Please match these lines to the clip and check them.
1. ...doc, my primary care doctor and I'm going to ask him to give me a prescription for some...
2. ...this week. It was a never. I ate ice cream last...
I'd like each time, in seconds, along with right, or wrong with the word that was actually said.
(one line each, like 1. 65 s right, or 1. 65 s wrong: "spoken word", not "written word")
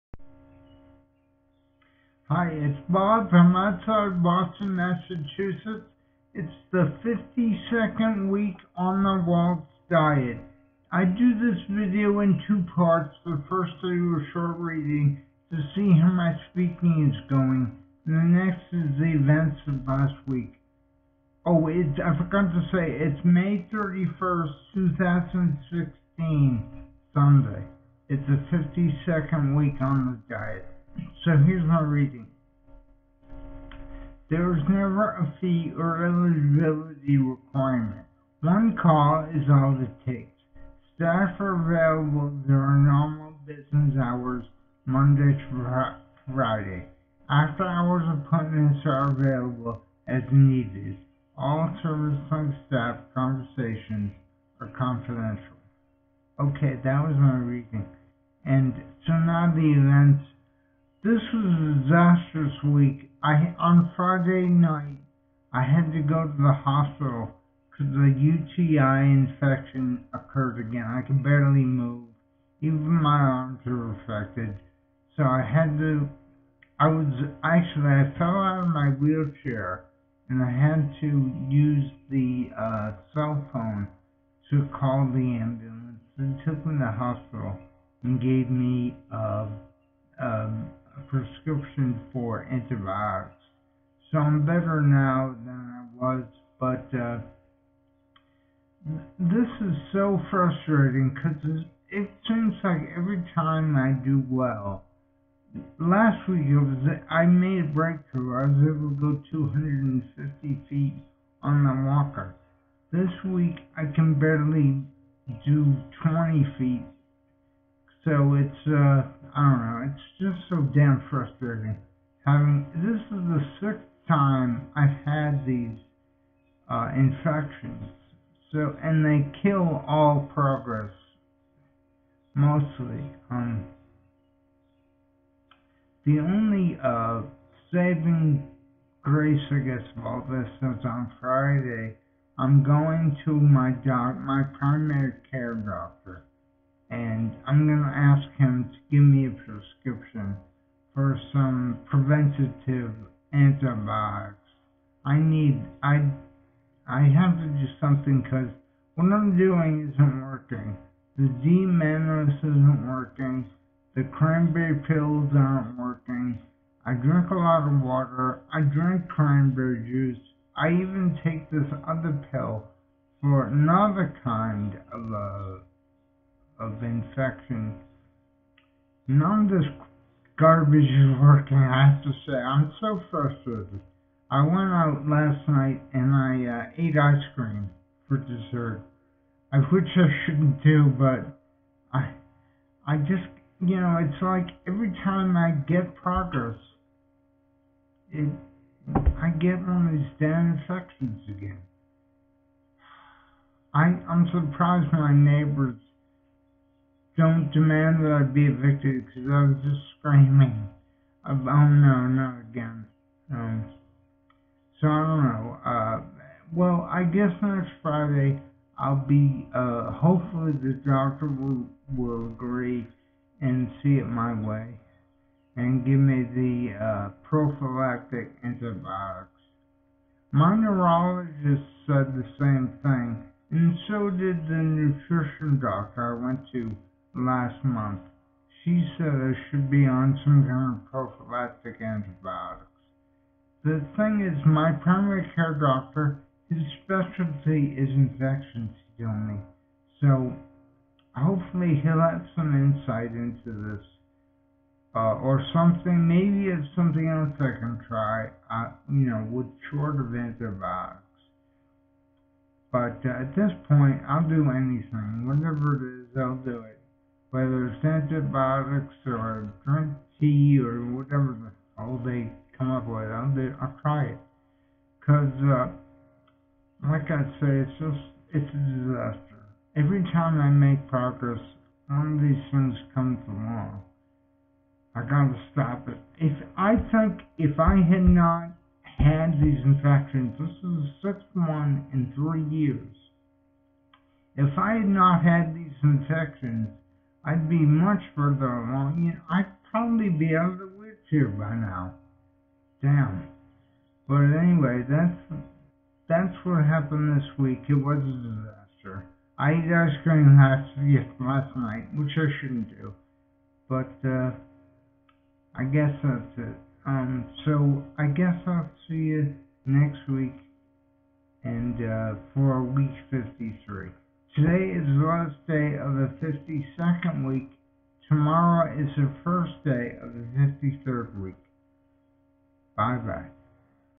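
1. 143 s right
2. 307 s wrong: "disaster", not "never".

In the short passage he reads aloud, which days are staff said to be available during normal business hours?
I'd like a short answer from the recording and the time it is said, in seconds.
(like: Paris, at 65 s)
Monday to Friday, at 44 s.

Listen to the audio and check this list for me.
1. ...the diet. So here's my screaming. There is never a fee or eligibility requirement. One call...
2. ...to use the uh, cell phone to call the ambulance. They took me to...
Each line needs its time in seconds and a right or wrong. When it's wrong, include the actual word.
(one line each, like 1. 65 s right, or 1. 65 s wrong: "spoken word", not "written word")
1. 30 s wrong: "reading", not "screaming"
2. 81 s right.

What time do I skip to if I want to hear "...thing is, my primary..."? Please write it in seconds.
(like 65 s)
243 s.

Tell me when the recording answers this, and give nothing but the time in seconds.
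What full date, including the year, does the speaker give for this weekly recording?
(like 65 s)
23 s.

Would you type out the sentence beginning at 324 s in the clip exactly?
Today is the last day of the 52nd week.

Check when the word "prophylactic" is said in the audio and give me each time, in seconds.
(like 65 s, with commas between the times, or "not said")
227 s, 240 s.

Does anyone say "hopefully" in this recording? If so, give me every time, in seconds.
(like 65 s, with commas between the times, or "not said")
219 s, 251 s.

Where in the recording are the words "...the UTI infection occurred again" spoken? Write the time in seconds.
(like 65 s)
67 s.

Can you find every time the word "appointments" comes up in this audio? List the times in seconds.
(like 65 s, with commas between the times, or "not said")
48 s.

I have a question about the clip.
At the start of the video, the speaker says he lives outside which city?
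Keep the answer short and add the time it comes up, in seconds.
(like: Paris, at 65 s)
Boston, at 4 s.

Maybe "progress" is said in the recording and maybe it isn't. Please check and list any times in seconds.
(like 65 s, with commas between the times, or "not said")
130 s, 195 s, 280 s.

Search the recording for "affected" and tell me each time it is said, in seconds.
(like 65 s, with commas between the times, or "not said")
73 s.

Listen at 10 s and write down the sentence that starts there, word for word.
I do this video in two parts.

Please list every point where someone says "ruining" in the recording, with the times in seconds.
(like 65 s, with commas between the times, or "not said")
not said.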